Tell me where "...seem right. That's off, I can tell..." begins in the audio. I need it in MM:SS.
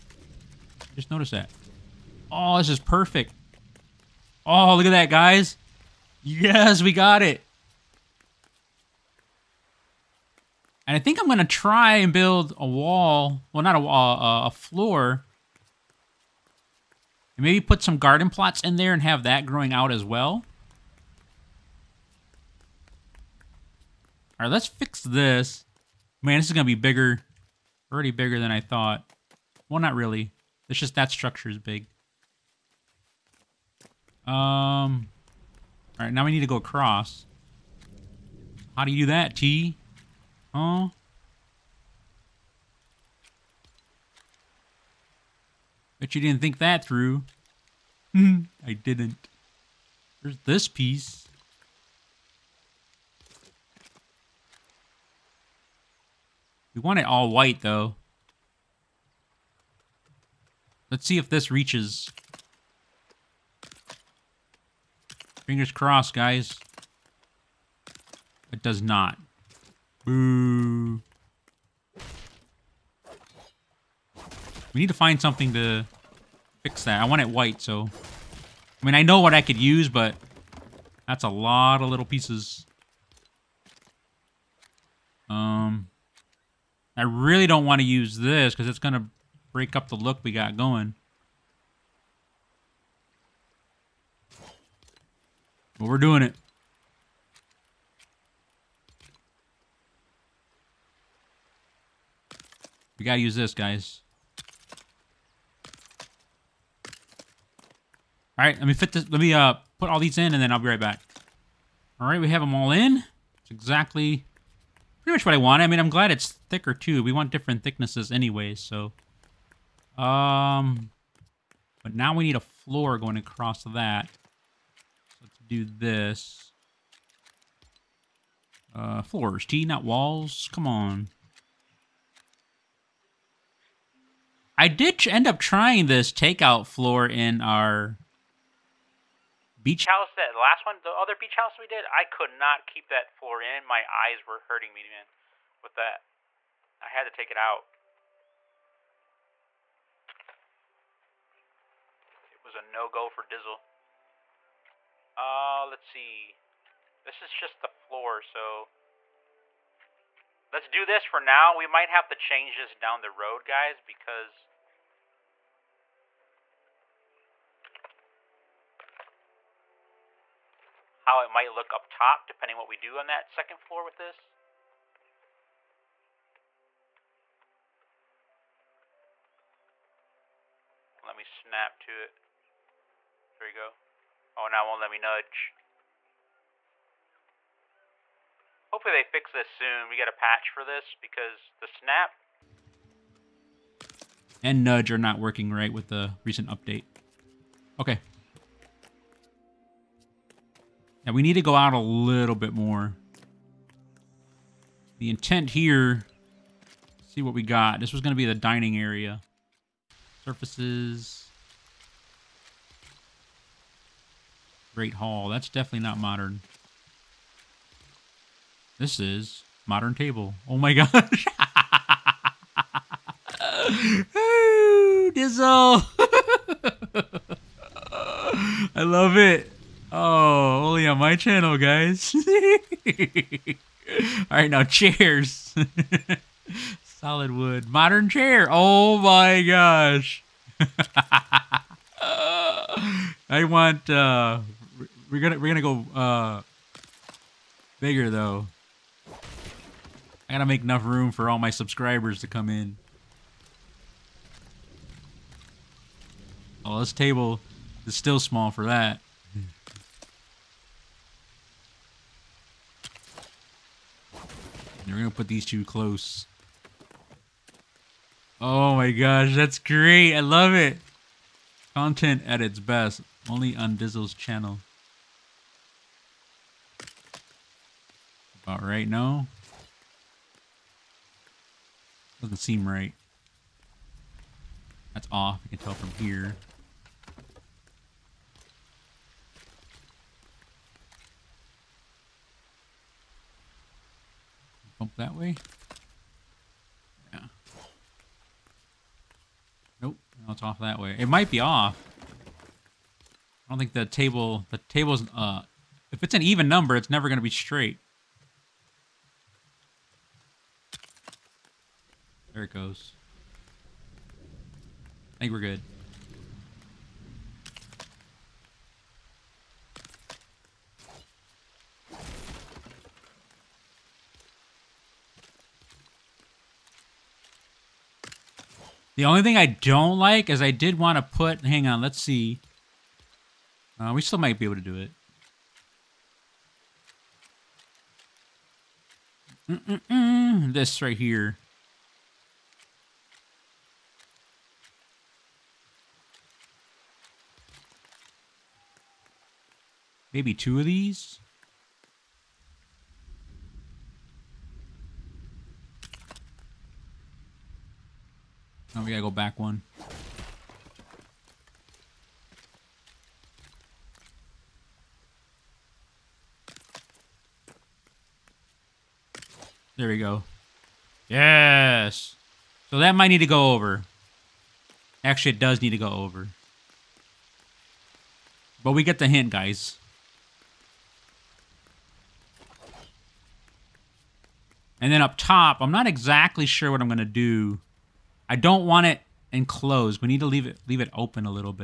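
04:42.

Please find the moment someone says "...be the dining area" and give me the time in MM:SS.
03:28.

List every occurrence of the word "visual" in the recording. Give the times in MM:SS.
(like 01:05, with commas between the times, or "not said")
not said.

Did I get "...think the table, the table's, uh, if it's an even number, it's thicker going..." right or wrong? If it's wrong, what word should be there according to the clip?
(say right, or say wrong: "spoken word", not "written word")
wrong: "never", not "thicker".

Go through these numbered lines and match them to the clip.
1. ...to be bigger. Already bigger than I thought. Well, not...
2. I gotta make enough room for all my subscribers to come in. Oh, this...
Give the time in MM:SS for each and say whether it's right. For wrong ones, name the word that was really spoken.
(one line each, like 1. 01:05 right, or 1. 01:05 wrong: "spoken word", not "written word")
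1. 00:26 right
2. 04:09 right.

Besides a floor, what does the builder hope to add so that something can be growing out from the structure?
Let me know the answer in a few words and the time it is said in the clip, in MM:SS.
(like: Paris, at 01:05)
Garden plots, at 00:17.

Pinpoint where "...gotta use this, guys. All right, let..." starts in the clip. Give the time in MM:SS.
01:43.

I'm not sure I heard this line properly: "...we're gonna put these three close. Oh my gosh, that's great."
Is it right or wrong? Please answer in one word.
wrong.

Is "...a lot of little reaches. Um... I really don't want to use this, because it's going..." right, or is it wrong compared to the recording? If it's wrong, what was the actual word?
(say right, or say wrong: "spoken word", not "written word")
wrong: "pieces", not "reaches".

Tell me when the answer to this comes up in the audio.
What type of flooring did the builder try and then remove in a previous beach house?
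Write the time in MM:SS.
02:16.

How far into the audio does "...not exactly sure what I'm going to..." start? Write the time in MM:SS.
06:25.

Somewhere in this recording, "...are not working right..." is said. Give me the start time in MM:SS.
03:14.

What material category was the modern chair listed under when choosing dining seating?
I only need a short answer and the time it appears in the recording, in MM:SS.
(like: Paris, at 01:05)
Solid wood, at 03:56.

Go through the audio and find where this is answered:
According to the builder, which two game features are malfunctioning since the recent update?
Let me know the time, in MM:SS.
03:11.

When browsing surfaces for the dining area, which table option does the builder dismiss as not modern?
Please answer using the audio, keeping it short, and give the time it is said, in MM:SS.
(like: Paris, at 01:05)
Great Hall, at 03:34.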